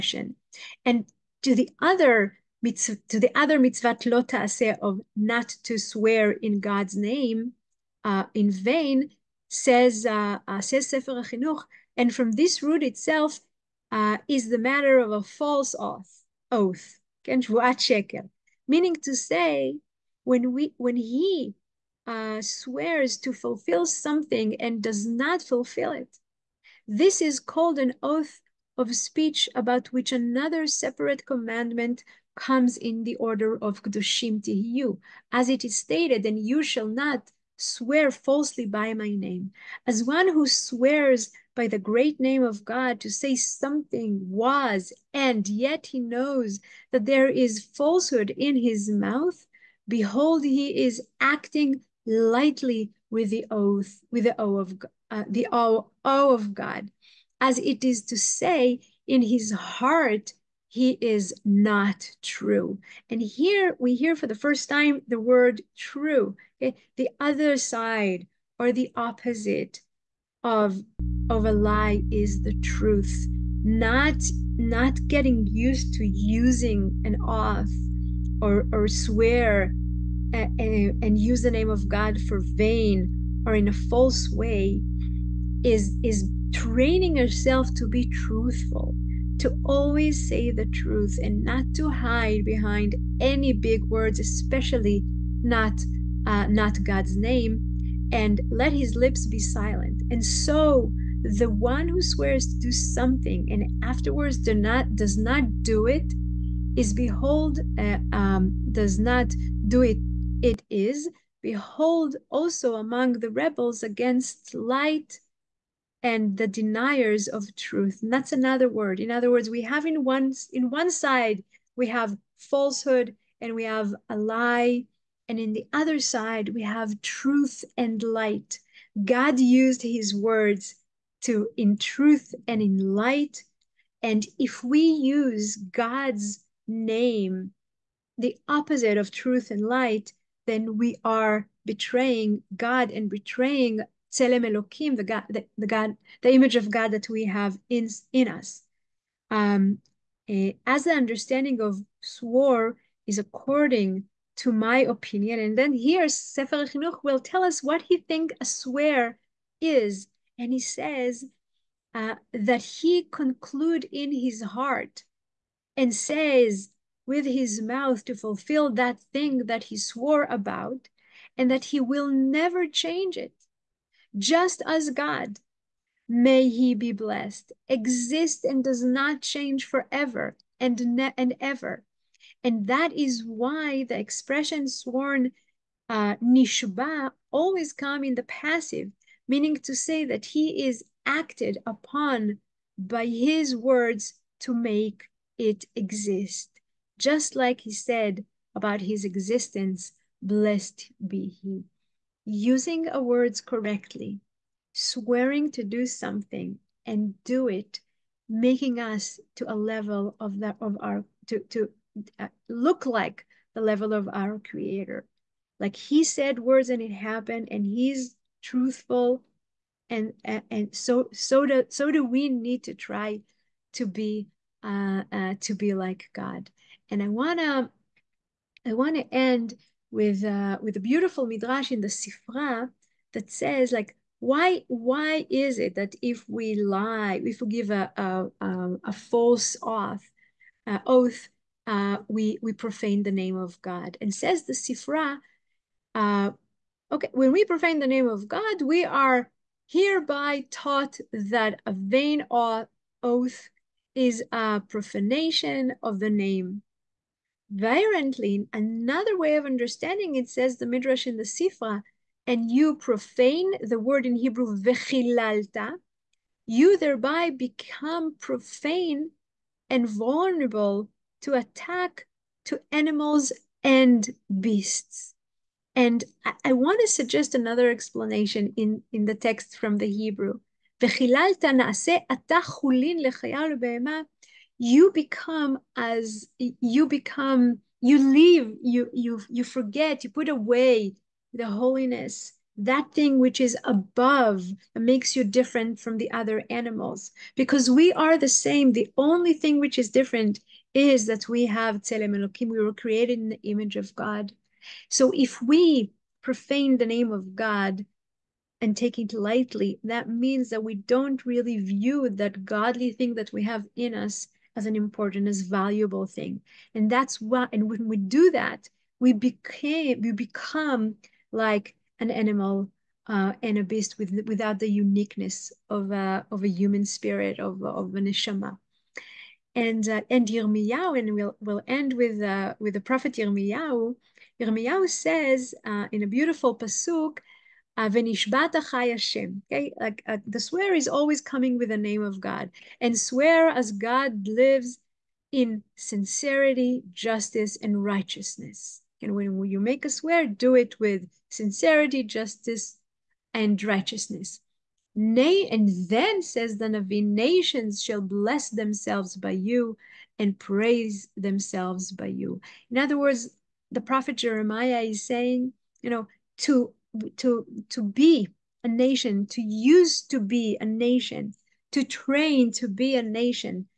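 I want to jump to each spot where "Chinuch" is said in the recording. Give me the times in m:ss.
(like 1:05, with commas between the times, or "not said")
0:11, 2:36.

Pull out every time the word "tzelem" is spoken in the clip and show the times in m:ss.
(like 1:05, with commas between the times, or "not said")
2:24, 5:01.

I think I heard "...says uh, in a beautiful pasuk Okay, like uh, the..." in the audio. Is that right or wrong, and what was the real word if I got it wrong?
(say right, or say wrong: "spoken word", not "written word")
right.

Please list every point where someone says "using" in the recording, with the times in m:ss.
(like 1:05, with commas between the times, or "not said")
1:16, 3:22.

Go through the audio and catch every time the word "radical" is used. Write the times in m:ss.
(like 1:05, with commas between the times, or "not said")
not said.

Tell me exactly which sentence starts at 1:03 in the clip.
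And here we hear for the first time the word true, okay?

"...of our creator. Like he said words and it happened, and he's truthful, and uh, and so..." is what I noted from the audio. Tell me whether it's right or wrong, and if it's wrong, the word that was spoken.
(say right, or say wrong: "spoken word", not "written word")
right.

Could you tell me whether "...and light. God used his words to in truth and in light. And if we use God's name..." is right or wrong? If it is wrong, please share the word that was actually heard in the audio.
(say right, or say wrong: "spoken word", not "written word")
right.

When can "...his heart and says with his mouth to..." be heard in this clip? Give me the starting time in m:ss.
2:44.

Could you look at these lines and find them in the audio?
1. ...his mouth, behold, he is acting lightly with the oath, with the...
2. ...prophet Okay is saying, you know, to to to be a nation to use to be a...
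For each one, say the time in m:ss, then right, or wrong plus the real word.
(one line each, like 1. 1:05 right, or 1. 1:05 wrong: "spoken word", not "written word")
1. 0:48 right
2. 6:03 wrong: "Jeremiah", not "Okay".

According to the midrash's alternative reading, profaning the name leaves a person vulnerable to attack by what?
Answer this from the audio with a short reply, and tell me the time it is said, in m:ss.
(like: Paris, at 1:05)
Animals and beasts, at 4:32.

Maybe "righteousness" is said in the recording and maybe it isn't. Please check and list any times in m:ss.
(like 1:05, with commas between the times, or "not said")
5:47, 5:53.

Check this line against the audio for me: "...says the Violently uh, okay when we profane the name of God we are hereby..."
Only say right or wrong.
wrong.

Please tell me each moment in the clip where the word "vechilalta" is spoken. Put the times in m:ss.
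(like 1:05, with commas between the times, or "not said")
4:24, 4:40.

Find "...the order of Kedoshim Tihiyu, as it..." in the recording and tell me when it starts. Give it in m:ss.
0:33.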